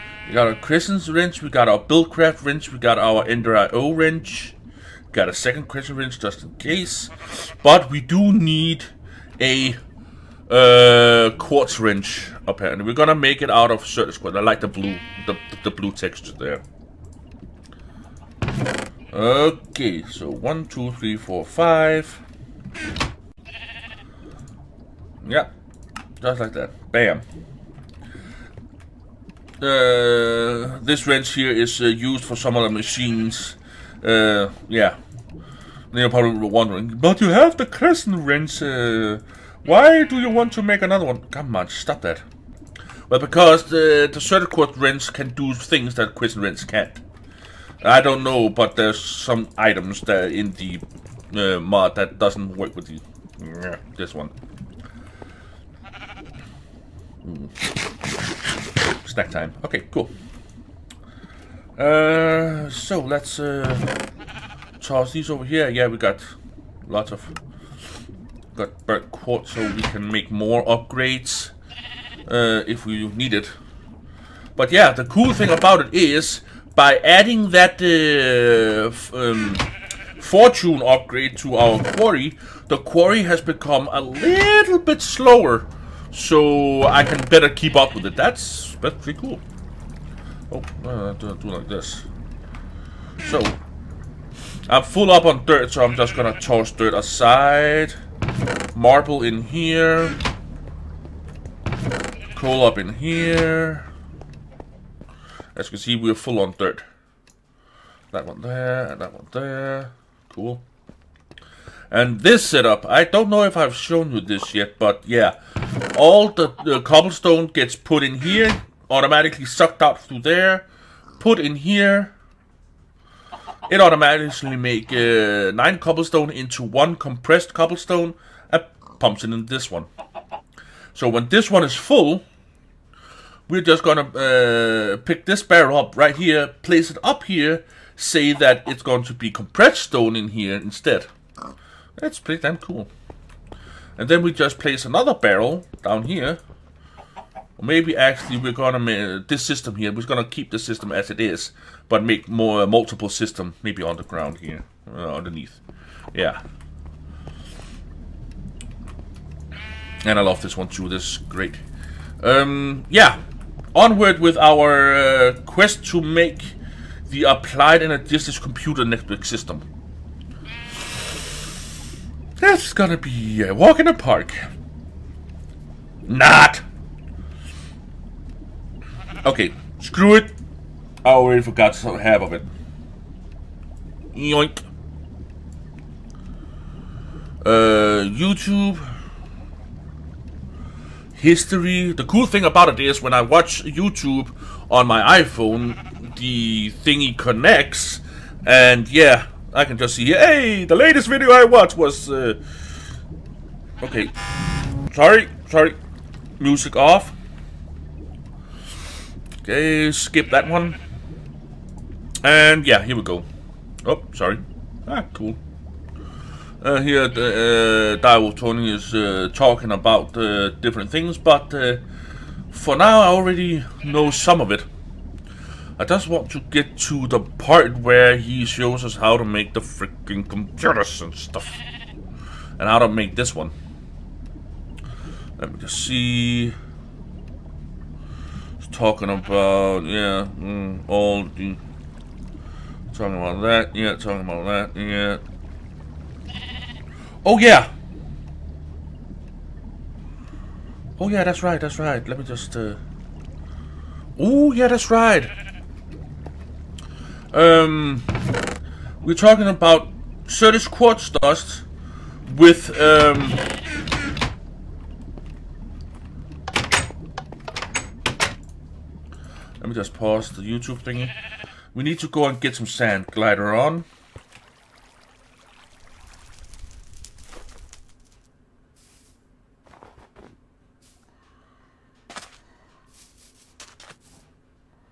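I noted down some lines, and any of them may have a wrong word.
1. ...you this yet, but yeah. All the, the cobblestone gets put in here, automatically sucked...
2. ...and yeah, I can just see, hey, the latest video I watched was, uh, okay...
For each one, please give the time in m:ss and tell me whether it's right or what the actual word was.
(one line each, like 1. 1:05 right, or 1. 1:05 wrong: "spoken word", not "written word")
1. 1:54 right
2. 3:18 right.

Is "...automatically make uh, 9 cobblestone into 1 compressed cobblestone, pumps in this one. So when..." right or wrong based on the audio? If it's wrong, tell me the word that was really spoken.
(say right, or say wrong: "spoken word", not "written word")
right.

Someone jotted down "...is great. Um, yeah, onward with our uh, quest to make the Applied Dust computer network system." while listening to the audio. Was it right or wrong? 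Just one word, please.
wrong.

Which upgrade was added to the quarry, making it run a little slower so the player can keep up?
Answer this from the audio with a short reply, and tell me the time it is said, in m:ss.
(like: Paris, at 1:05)
Fortune upgrade, at 1:20.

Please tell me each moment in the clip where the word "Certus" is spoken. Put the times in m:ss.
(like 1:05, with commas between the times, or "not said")
0:13, 0:44, 4:20.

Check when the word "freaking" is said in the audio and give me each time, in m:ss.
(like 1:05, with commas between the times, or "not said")
3:49.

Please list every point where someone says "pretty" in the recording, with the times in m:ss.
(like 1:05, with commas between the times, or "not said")
1:29, 2:22.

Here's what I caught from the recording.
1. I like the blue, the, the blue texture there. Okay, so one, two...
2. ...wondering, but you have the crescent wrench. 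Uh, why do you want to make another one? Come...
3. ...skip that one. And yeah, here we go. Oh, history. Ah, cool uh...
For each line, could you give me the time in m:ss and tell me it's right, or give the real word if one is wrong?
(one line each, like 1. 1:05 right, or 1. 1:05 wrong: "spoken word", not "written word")
1. 0:14 right
2. 0:36 right
3. 3:29 wrong: "sorry", not "history".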